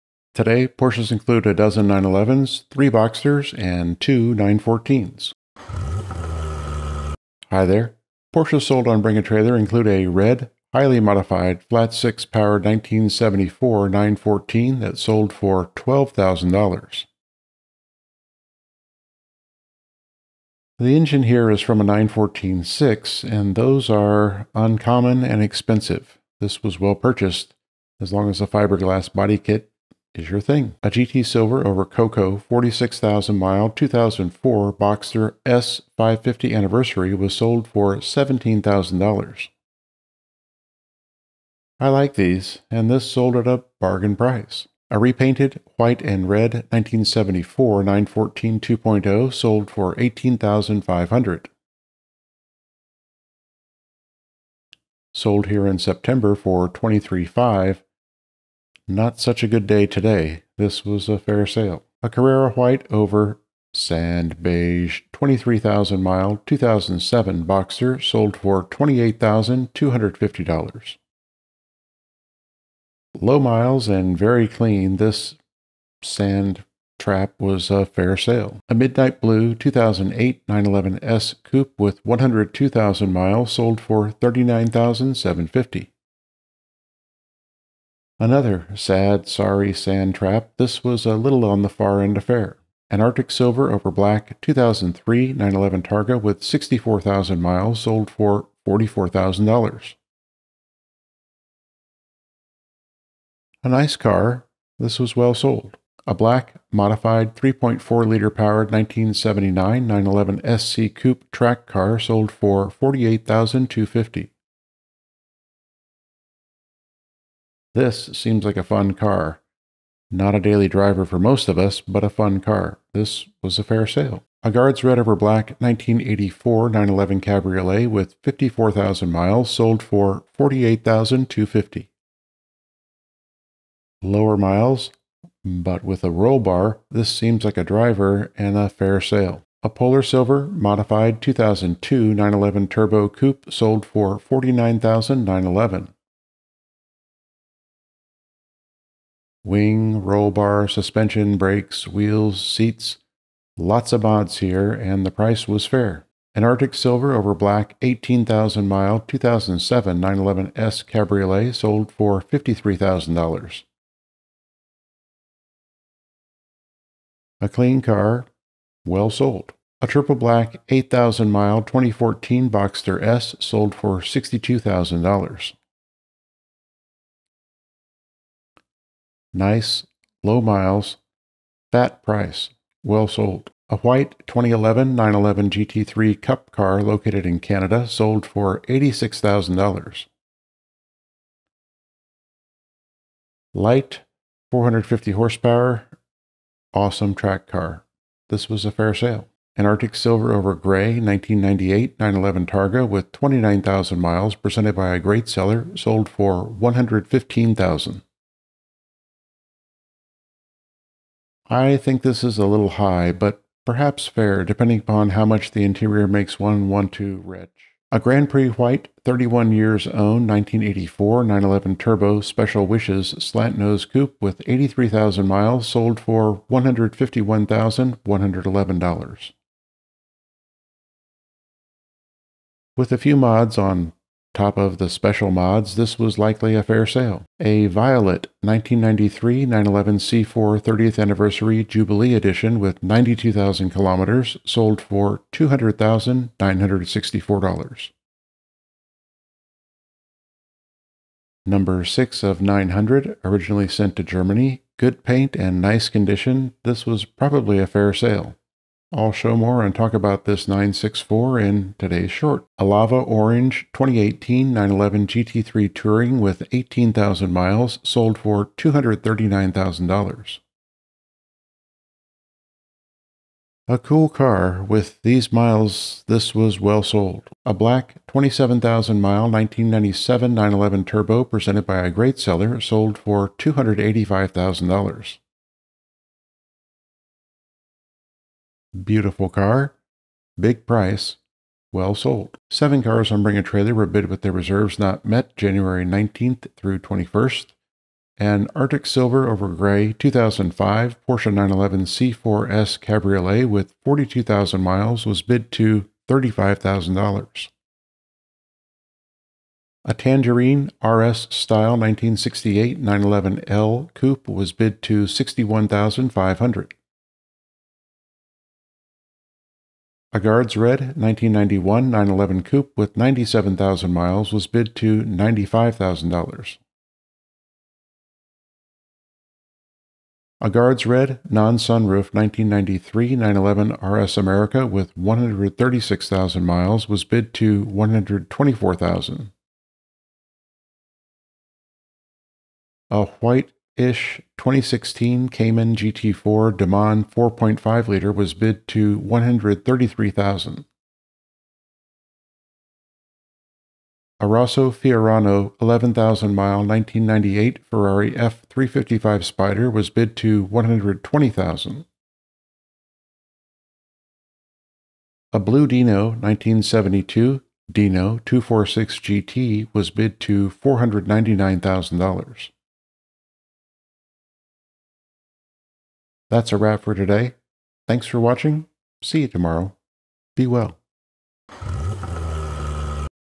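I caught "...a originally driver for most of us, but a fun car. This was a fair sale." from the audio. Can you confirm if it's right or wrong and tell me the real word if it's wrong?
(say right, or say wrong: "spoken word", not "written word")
wrong: "daily", not "originally".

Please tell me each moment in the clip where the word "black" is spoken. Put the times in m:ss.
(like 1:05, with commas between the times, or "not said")
1:33, 1:46, 2:05, 2:37, 2:50, 4:37.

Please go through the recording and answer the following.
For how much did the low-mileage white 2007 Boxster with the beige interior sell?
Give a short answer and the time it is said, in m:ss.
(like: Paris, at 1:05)
$28,250, at 1:08.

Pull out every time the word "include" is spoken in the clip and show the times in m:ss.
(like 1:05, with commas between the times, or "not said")
0:01, 0:09.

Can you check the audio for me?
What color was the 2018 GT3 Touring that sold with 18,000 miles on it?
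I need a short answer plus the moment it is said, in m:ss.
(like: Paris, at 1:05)
Lava Orange, at 4:22.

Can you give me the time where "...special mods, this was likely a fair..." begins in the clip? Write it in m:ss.
3:54.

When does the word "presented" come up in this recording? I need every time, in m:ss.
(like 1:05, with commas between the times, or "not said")
3:24, 4:41.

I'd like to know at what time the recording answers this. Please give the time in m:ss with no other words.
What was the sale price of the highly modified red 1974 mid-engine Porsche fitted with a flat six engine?
0:15.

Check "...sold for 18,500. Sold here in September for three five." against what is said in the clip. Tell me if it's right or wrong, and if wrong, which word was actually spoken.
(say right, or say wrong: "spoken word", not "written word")
right.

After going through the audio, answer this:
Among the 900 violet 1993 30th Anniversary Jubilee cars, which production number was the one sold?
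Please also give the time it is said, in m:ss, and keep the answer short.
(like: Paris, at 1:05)
6, at 4:11.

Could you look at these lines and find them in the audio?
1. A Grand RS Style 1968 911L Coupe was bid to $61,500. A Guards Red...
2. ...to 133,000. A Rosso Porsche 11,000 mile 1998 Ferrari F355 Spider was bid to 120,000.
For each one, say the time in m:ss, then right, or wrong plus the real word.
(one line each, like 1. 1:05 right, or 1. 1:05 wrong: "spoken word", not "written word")
1. 5:09 wrong: "Tangerine", not "Grand"
2. 5:48 wrong: "Fiorano", not "Porsche".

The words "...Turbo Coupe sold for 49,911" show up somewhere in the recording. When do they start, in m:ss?
2:22.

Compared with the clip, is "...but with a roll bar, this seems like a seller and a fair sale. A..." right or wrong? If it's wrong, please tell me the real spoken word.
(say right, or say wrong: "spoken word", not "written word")
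wrong: "driver", not "seller".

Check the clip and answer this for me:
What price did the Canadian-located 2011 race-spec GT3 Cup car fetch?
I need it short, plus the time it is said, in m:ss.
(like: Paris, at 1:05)
$86,000, at 3:08.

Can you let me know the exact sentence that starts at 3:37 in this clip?
A Grand Prix White, 31 years owned, 1984 911 Turbo Special Wishes slant nose coupe with 83,000 miles sold for $151,111.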